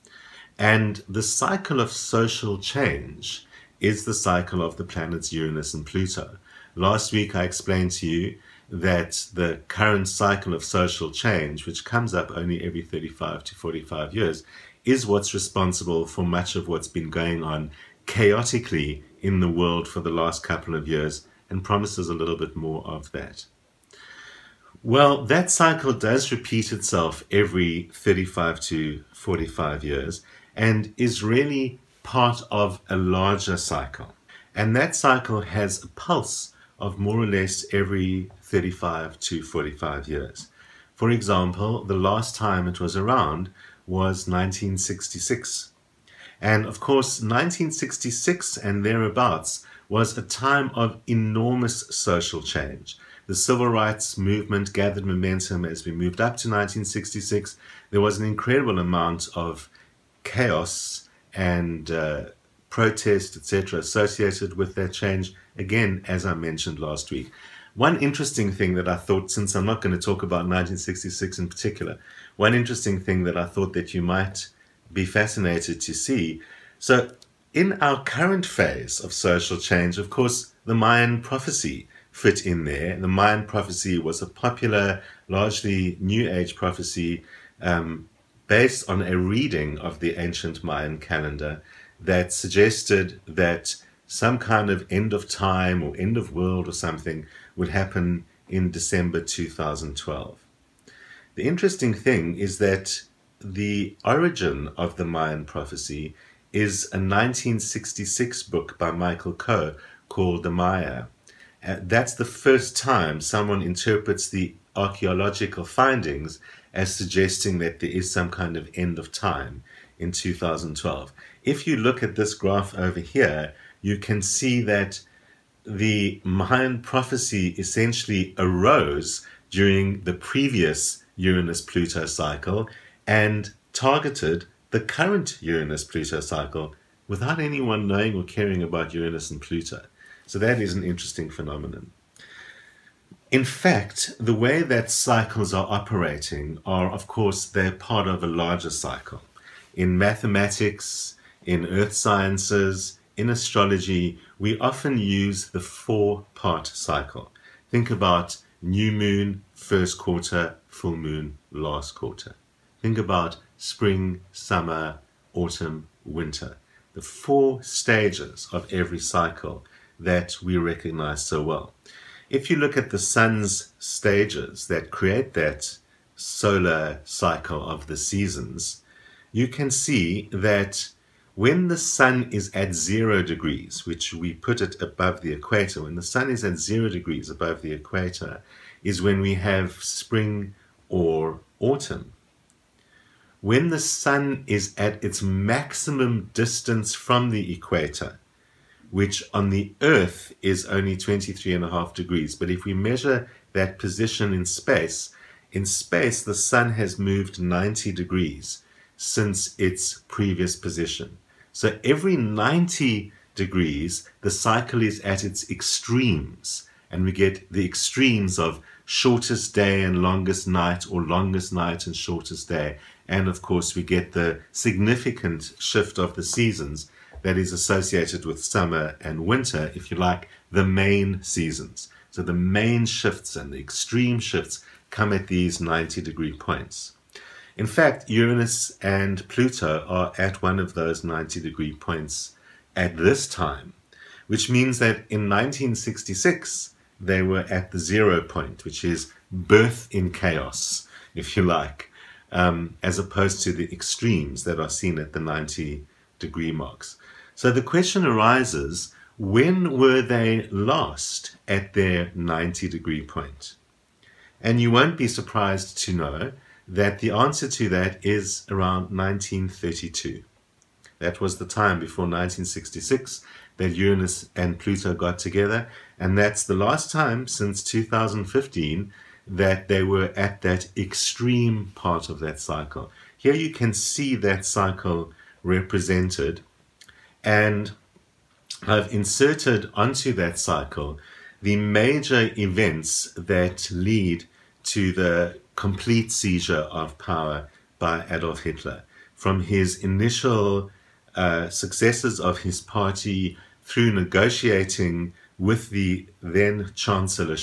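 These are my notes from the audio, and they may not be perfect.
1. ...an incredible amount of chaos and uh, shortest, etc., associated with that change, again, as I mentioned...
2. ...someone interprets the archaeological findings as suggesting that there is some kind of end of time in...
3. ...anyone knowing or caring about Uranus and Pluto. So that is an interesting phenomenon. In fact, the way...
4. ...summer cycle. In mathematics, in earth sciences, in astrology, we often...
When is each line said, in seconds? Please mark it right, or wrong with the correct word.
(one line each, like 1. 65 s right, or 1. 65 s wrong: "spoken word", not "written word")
1. 58 s wrong: "protest", not "shortest"
2. 113 s right
3. 137 s right
4. 148 s wrong: "larger", not "summer".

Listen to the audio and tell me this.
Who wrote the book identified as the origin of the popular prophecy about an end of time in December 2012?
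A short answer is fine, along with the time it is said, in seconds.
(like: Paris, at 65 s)
Michael Coe, at 108 s.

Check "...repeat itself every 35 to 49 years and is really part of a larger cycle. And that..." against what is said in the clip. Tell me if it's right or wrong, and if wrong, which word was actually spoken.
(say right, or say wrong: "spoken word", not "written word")
wrong: "45", not "49".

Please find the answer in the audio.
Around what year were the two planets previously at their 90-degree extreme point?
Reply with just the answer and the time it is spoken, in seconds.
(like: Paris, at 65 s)
1932, at 268 s.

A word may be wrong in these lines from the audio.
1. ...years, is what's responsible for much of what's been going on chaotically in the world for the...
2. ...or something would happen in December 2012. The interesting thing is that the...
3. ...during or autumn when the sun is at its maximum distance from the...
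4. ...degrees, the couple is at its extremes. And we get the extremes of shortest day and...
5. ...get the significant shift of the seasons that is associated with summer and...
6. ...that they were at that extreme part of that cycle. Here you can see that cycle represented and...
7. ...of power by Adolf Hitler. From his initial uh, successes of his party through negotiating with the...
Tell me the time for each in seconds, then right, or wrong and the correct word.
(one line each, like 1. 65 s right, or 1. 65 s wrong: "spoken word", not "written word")
1. 14 s right
2. 96 s right
3. 189 s wrong: "spring", not "during"
4. 213 s wrong: "cycle", not "couple"
5. 223 s right
6. 279 s right
7. 296 s right.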